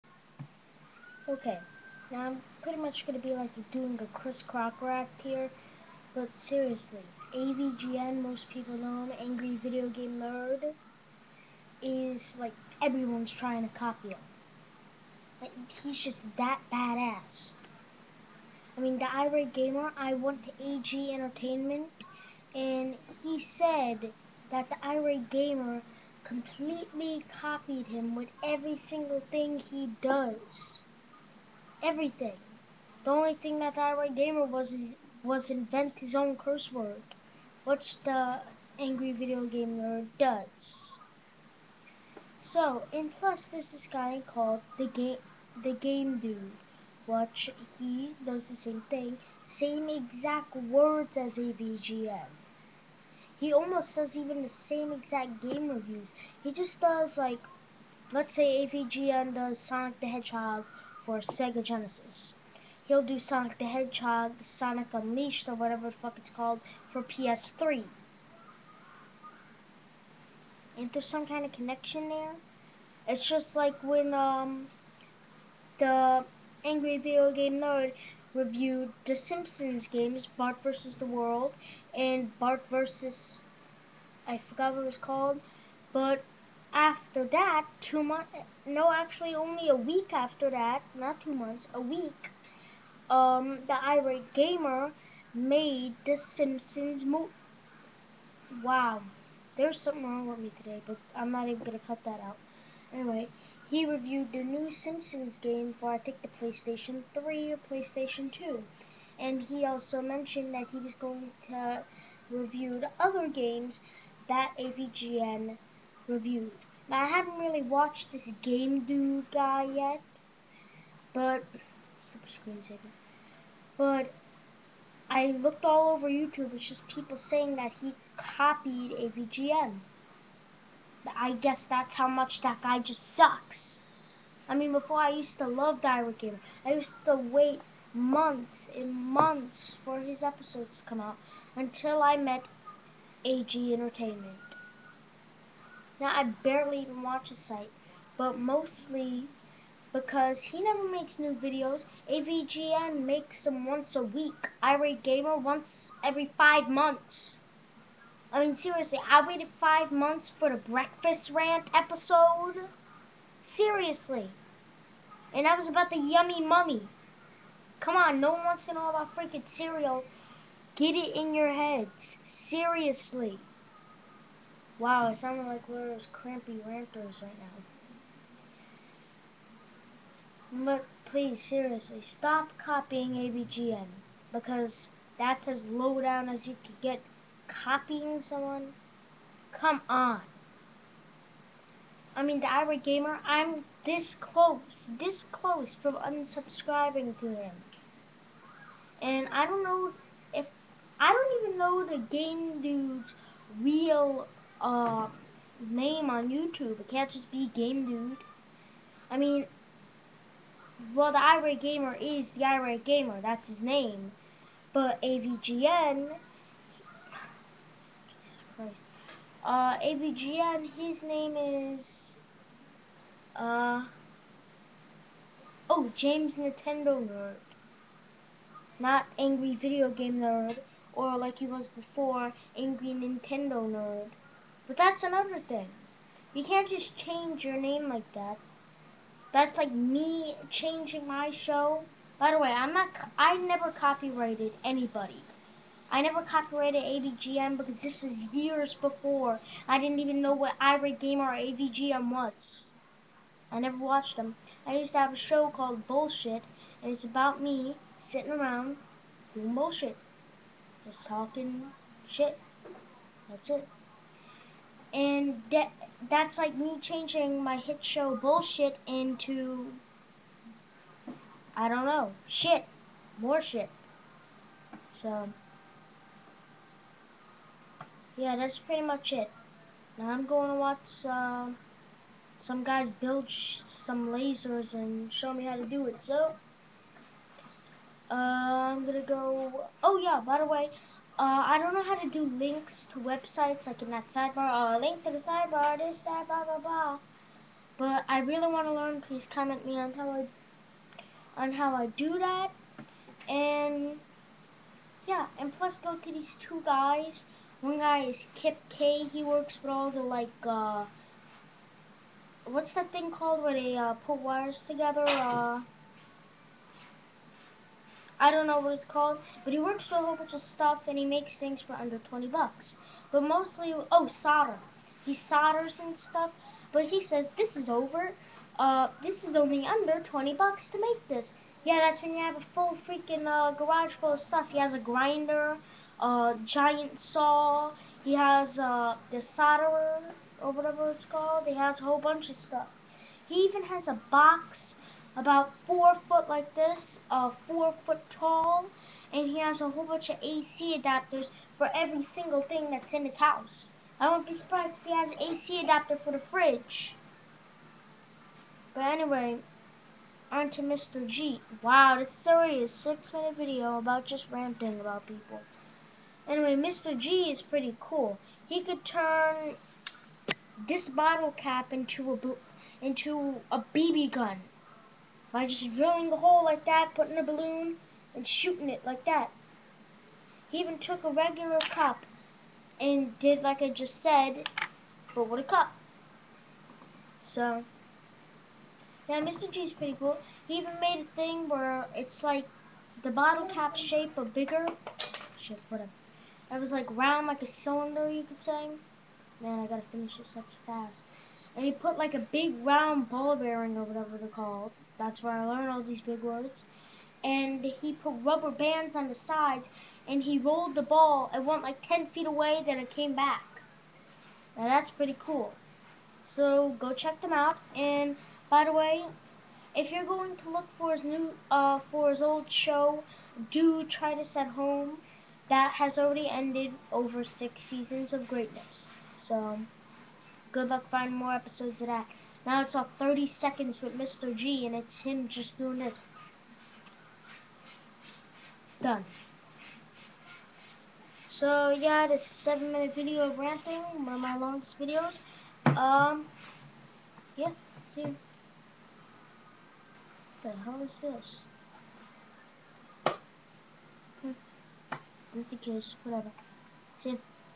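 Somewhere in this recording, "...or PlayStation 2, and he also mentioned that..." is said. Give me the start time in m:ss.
1:47.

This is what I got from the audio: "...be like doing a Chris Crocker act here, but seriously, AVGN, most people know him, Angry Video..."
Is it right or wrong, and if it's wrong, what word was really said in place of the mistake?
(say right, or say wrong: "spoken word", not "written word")
right.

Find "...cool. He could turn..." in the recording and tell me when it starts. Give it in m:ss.
6:07.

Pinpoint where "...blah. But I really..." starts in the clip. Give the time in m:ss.
4:56.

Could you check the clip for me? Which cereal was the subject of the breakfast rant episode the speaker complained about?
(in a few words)
Yummy Mummy.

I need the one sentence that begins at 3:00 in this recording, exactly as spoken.
But please, seriously, stop copying AVGN.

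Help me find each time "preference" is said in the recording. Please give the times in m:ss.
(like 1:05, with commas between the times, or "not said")
not said.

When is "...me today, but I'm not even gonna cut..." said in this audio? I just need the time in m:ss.
1:40.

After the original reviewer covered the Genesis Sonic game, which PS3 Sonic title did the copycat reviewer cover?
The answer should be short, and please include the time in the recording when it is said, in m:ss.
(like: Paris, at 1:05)
Sonic Unleashed, at 1:04.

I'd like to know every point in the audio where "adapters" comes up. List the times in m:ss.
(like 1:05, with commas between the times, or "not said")
5:50, 5:55.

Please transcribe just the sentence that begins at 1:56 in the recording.
Now, I haven't really watched this Game Dude guy yet, but screensaver.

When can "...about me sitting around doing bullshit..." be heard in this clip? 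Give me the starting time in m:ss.
4:17.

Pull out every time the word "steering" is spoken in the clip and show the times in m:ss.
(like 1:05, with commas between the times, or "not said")
not said.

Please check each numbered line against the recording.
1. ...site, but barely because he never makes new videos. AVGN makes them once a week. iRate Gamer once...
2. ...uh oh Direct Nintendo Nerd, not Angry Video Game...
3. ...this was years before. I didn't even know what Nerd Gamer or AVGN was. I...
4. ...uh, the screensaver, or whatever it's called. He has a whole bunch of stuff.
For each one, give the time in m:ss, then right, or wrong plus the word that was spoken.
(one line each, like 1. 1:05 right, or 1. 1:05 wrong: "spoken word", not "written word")
1. 2:27 wrong: "mostly", not "barely"
2. 3:43 wrong: "James", not "Direct"
3. 4:07 wrong: "Irate", not "Nerd"
4. 5:38 wrong: "solderer", not "screensaver".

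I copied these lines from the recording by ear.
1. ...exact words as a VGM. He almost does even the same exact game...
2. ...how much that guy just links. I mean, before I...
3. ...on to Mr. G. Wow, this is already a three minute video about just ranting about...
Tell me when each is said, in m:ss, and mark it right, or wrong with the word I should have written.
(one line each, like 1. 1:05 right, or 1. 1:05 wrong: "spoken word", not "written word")
1. 0:49 right
2. 2:11 wrong: "sucks", not "links"
3. 6:00 wrong: "six", not "three".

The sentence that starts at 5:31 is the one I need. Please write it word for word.
Yeah, that's when you have a full freaking uh, garage full of stuff.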